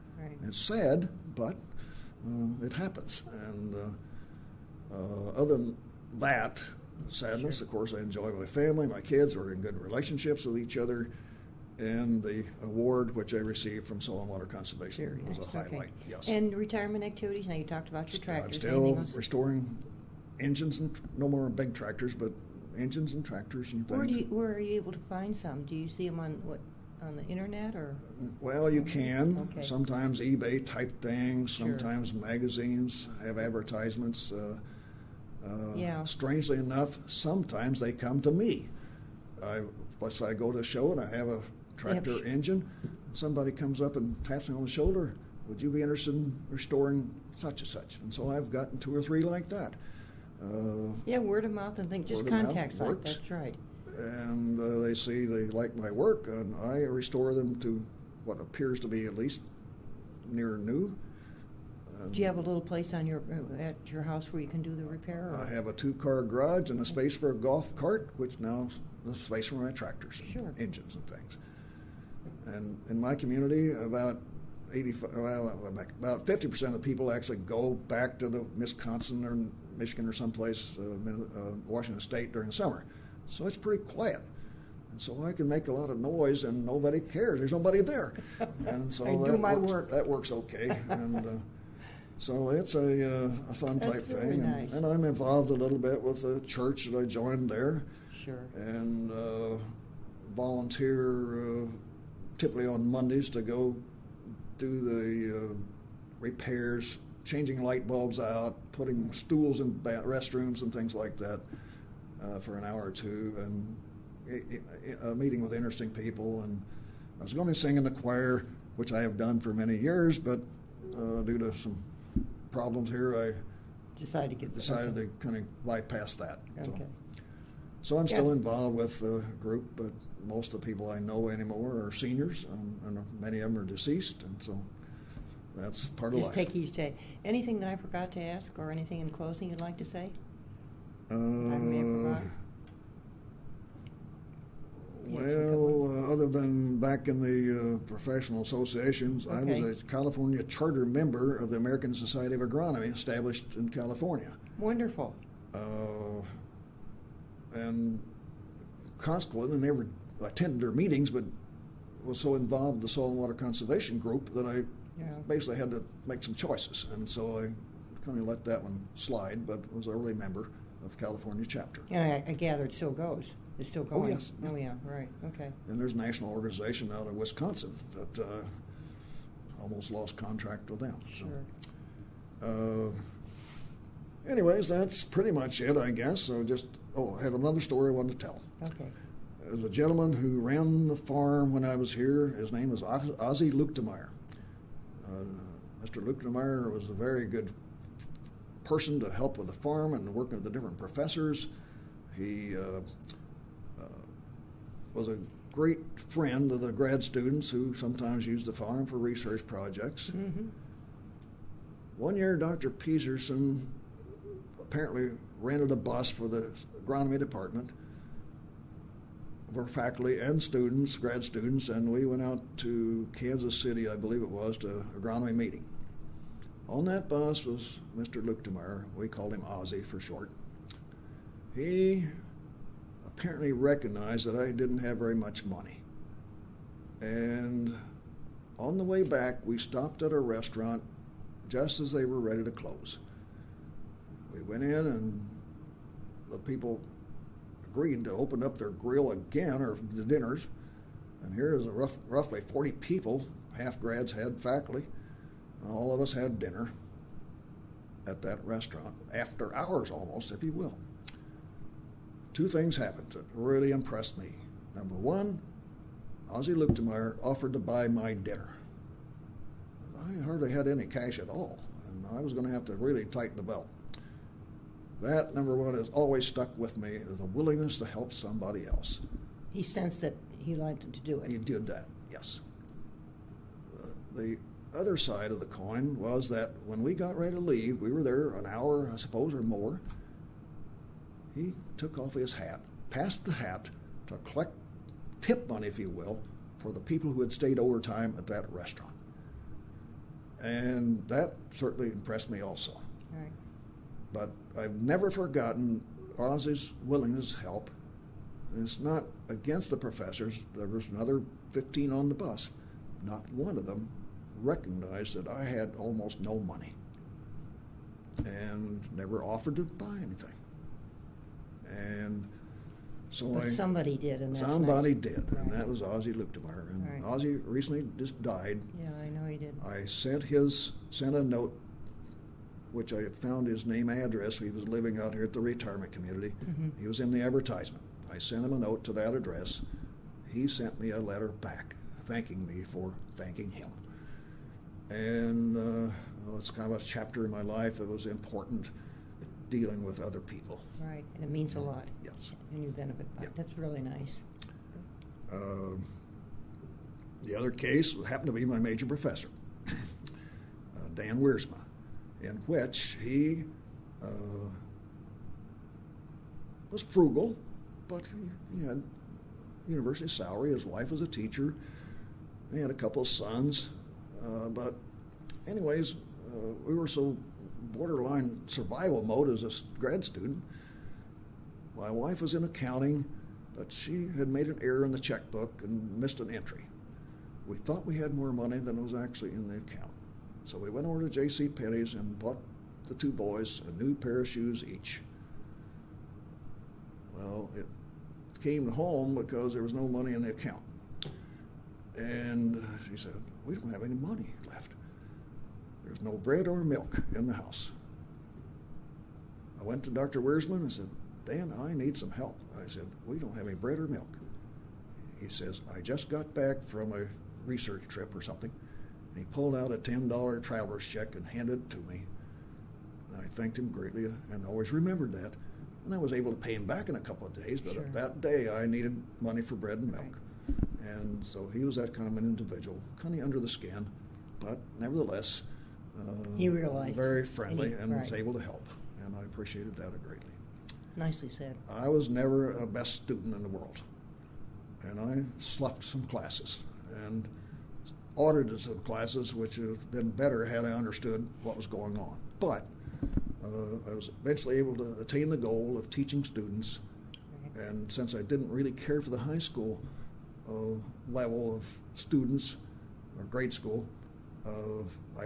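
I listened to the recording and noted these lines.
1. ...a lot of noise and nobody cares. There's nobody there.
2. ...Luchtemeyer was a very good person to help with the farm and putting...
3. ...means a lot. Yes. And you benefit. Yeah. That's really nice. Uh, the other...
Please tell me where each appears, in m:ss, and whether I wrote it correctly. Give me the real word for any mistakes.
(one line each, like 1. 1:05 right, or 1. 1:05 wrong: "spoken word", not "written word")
1. 1:25 right
2. 3:16 wrong: "working", not "putting"
3. 5:51 right.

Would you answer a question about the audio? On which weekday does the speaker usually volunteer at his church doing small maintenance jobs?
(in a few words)
Mondays.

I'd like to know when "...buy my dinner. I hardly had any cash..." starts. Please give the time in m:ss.
4:27.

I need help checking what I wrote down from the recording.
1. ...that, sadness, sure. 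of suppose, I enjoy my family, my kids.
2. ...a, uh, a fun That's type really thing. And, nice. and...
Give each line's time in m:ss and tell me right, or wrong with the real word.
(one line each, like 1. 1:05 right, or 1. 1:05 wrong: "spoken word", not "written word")
1. 0:06 wrong: "course", not "suppose"
2. 1:32 right.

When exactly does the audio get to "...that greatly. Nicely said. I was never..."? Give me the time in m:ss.
7:19.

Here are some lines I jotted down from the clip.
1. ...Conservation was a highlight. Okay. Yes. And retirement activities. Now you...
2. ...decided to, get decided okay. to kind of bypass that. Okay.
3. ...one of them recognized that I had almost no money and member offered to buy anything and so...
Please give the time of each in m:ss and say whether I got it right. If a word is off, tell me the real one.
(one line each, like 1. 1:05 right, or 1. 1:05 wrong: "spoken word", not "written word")
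1. 0:14 right
2. 2:03 right
3. 5:13 wrong: "never", not "member".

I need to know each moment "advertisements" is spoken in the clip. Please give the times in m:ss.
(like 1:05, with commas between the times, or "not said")
0:33, 5:37.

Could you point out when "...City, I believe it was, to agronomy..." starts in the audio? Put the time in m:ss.
3:43.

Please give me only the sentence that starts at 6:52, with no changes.
I said, We don't have any bread or milk.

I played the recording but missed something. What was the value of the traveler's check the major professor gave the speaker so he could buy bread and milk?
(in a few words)
$10.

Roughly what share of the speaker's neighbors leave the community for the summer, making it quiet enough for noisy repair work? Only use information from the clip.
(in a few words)
50 percent.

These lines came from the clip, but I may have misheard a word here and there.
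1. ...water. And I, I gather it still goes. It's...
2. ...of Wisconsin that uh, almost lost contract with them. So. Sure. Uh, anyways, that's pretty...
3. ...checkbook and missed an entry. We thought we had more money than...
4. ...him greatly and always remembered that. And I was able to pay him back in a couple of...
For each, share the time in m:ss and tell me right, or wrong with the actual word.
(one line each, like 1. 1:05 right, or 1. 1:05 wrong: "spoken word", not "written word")
1. 2:51 wrong: "chapter", not "water"
2. 2:57 right
3. 6:24 right
4. 7:03 right.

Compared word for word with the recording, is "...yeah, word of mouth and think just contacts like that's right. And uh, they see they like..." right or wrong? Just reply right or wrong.
right.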